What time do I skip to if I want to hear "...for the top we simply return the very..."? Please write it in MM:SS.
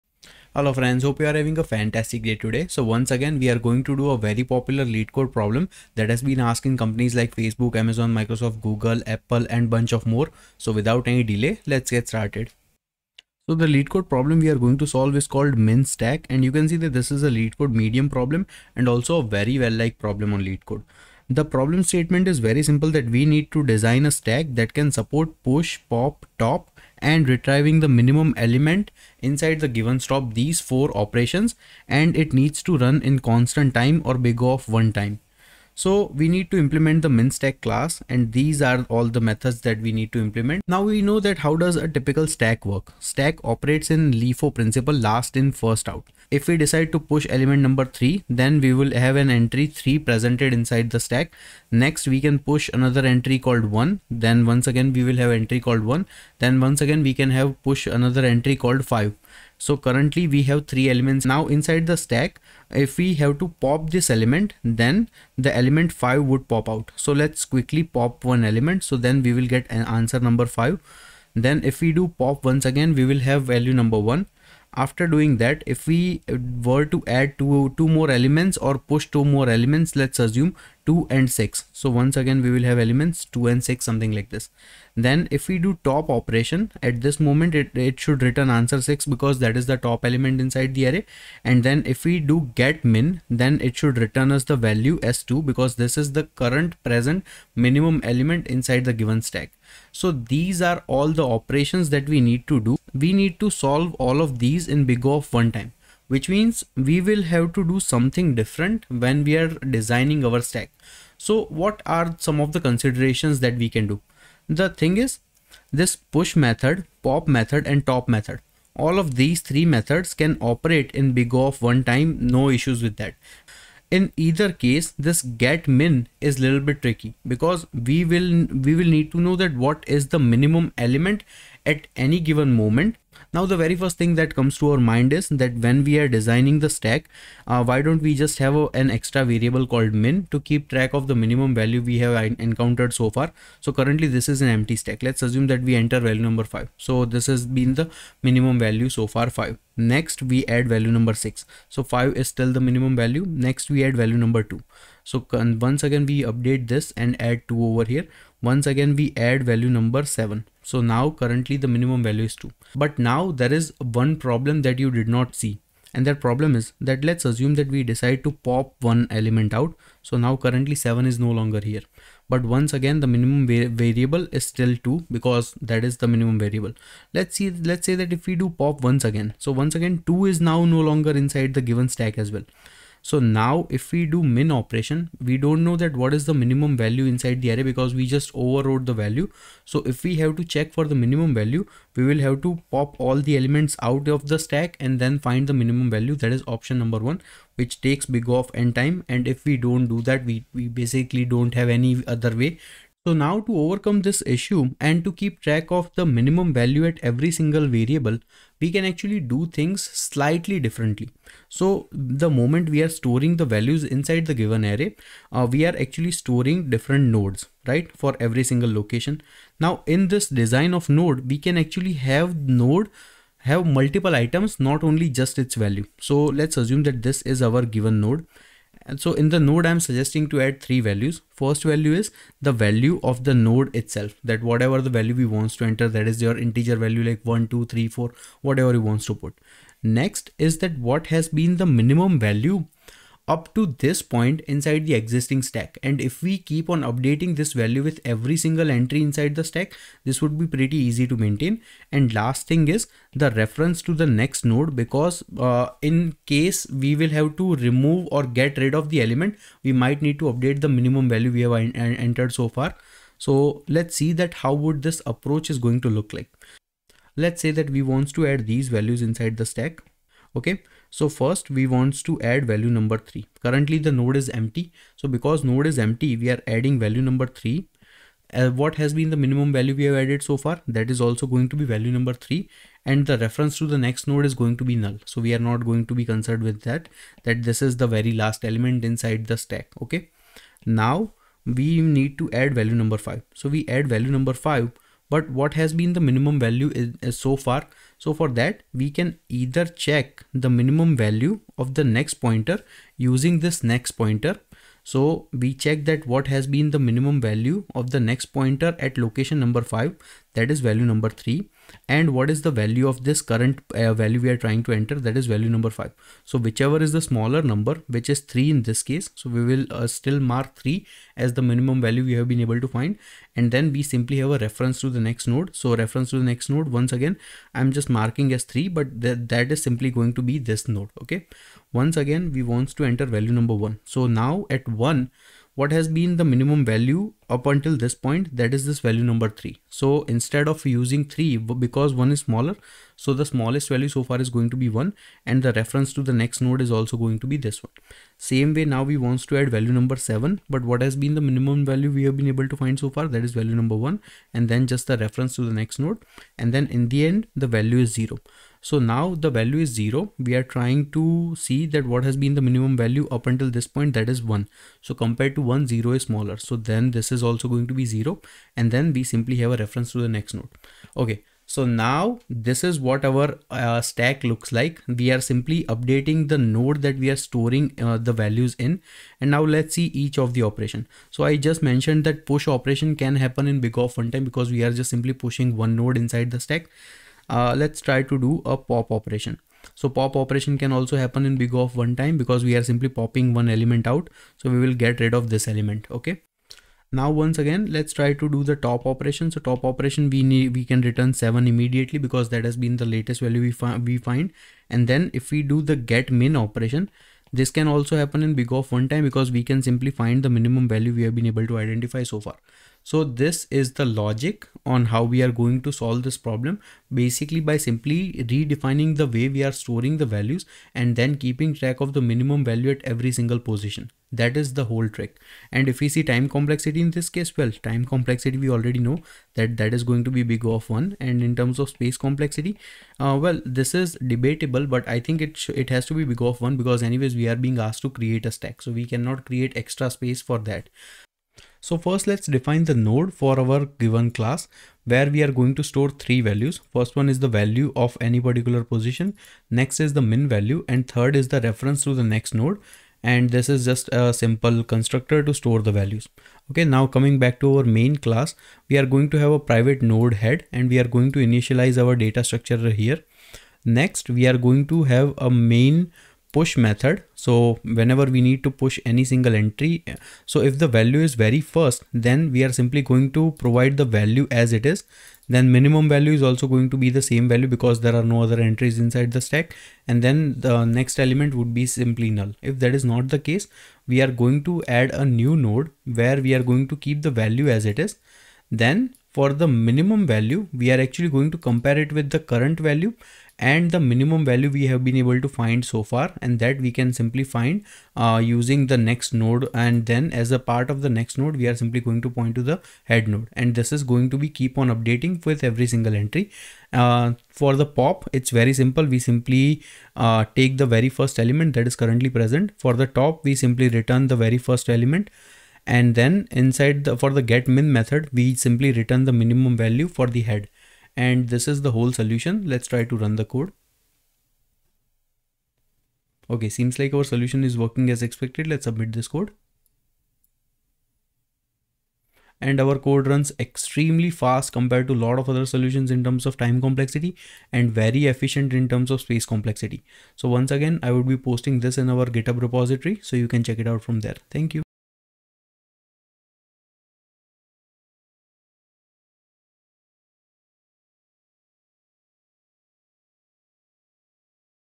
08:32.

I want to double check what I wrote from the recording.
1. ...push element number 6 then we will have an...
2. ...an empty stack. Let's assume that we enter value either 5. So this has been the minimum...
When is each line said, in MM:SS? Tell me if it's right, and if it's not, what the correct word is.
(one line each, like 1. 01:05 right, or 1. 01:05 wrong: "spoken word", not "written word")
1. 00:46 wrong: "3", not "6"
2. 02:24 wrong: "number", not "either".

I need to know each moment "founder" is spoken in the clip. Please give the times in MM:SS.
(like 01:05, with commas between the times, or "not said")
not said.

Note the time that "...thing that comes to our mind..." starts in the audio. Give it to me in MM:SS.
02:13.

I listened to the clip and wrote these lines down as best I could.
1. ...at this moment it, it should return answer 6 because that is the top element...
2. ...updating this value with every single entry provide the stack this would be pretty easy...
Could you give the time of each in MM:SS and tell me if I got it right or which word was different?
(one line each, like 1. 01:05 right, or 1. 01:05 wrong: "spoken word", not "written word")
1. 01:26 right
2. 04:06 wrong: "inside", not "provide".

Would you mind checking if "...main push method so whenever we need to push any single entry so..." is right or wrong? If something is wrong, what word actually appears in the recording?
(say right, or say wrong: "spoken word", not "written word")
right.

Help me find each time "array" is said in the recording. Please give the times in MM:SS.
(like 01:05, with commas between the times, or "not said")
01:30, 03:07, 03:34.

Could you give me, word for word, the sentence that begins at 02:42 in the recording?
But now there is one problem that you did not see.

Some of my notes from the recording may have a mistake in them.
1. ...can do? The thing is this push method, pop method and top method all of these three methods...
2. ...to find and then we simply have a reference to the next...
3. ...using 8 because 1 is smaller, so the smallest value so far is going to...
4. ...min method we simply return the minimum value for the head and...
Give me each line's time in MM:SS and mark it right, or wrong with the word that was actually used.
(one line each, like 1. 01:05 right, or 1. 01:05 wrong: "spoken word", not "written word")
1. 01:53 right
2. 05:22 right
3. 05:40 wrong: "3", not "8"
4. 08:37 right.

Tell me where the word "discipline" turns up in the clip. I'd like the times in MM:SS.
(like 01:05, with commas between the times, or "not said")
not said.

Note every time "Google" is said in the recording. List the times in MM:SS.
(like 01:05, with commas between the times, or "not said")
00:08.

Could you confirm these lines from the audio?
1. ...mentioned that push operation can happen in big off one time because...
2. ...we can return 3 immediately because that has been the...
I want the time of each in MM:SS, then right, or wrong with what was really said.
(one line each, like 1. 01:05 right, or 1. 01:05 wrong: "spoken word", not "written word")
1. 06:21 right
2. 06:40 wrong: "7", not "3".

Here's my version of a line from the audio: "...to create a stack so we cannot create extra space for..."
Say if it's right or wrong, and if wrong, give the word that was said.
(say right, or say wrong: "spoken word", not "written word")
right.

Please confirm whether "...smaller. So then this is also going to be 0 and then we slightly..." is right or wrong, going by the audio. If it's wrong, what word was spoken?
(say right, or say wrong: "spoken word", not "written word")
wrong: "simply", not "slightly".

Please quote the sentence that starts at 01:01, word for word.
Now inside the stack, if we have to pop this element, then the element 5 would pop out.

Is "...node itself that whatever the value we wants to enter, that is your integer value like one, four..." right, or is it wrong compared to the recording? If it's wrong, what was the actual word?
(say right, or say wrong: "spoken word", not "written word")
wrong: "two", not "four".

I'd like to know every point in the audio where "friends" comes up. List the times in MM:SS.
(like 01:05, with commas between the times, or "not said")
00:00.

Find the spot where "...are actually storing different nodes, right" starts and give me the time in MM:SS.
03:35.